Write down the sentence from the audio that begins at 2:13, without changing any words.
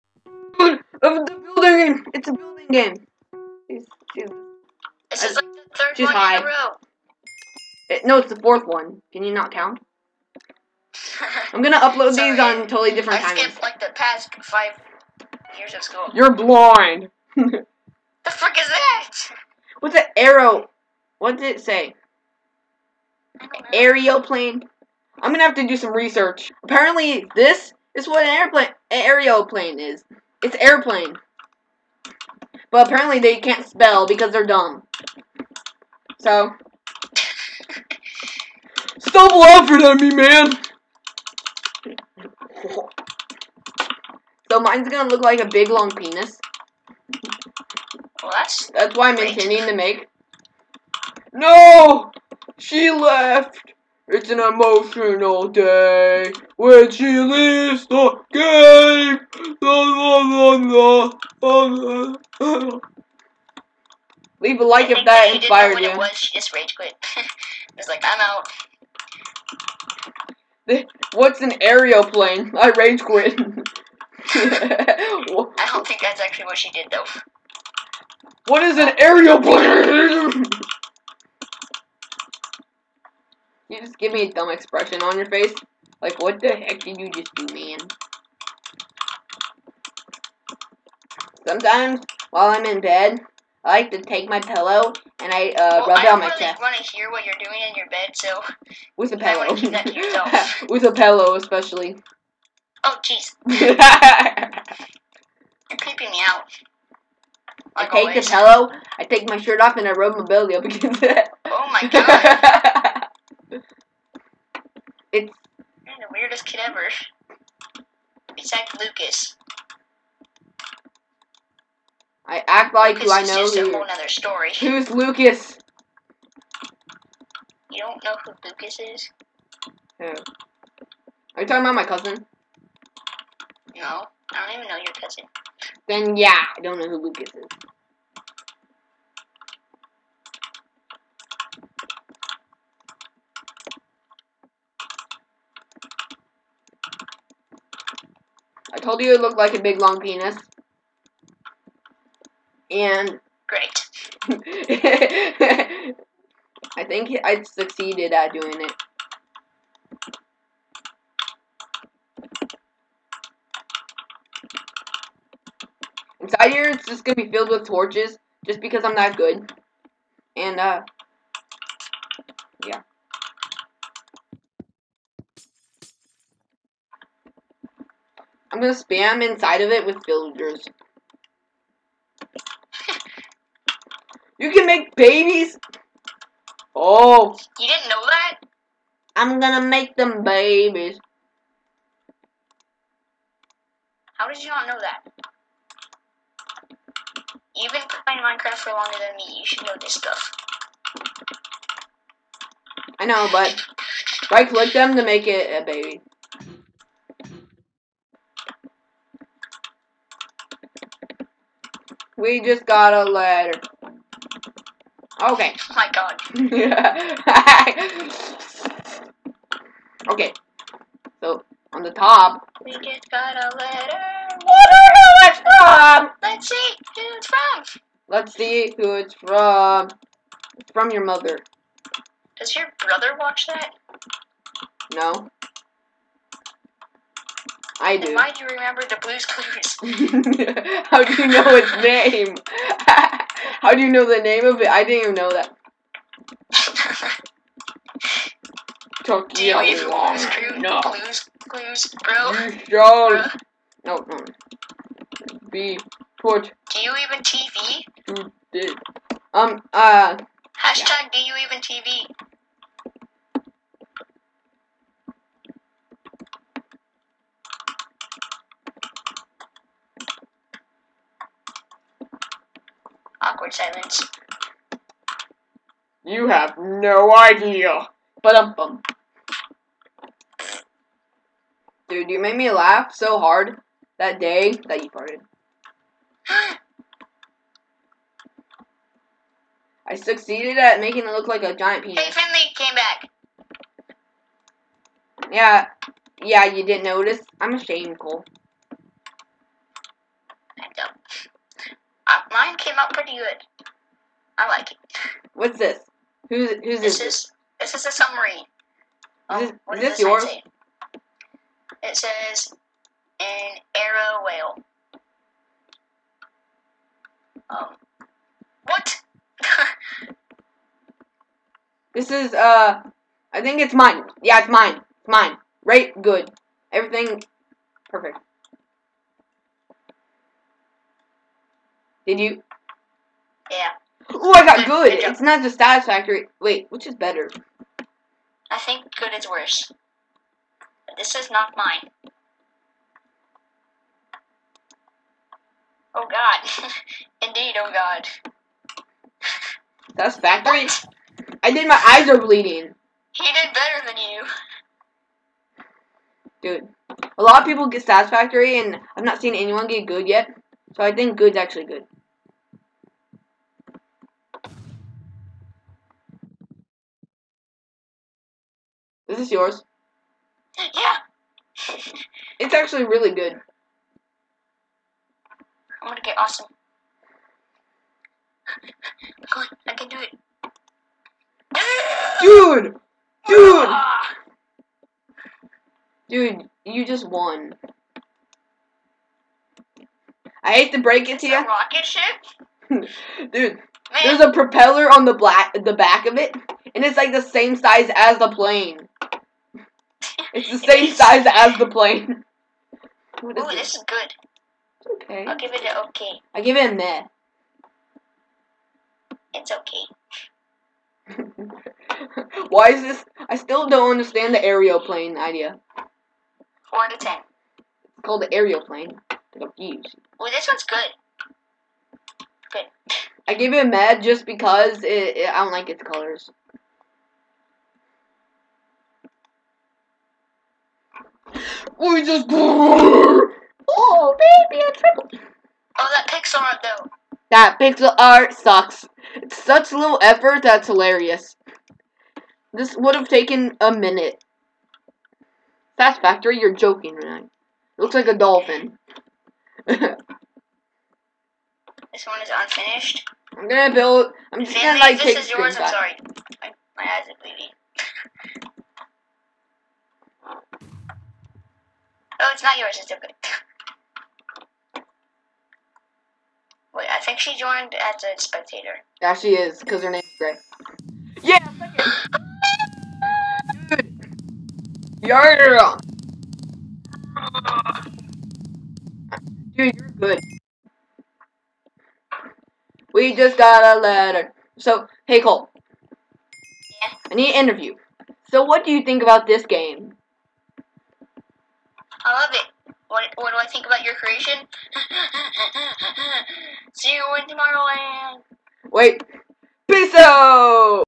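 No, I don't even know your cousin.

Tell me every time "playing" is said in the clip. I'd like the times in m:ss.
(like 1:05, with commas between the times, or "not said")
3:18.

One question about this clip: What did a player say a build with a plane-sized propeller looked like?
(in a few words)
Rocket ship.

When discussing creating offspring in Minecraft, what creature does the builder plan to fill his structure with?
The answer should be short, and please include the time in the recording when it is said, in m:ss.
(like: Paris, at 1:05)
Villagers, at 3:00.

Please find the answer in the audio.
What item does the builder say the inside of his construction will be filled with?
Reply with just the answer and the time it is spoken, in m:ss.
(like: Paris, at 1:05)
Torches, at 2:47.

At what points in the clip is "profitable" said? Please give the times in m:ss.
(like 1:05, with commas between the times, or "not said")
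not said.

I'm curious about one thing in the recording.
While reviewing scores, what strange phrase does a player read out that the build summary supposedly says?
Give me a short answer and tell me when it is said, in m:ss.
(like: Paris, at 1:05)
An arrow whale, at 5:13.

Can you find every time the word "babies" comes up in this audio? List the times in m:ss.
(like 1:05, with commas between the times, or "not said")
3:04, 3:10.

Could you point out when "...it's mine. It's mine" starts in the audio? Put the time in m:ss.
5:24.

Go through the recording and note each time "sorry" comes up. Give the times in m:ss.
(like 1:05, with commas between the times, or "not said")
7:35.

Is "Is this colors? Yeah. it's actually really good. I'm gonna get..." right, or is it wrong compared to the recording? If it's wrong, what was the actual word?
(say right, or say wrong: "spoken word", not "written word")
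wrong: "yours", not "colors".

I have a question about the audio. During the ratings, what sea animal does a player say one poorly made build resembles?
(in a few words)
Dolphin.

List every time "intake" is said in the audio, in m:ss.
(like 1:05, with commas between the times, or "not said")
not said.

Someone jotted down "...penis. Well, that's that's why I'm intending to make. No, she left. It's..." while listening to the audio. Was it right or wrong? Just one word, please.
right.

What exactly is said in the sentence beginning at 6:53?
I still don't understand the aeroplane idea.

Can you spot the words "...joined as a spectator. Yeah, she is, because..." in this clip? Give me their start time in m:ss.
7:47.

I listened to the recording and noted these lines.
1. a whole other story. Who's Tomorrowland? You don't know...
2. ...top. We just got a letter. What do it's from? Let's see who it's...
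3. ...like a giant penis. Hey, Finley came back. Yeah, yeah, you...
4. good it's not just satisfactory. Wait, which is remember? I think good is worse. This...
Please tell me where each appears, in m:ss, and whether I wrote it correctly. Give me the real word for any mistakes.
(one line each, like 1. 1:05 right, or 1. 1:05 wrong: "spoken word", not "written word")
1. 2:03 wrong: "Lucas", not "Tomorrowland"
2. 3:41 right
3. 4:51 right
4. 5:34 wrong: "better", not "remember".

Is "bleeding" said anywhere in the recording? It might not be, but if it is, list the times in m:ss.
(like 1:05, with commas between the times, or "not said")
5:52, 7:37.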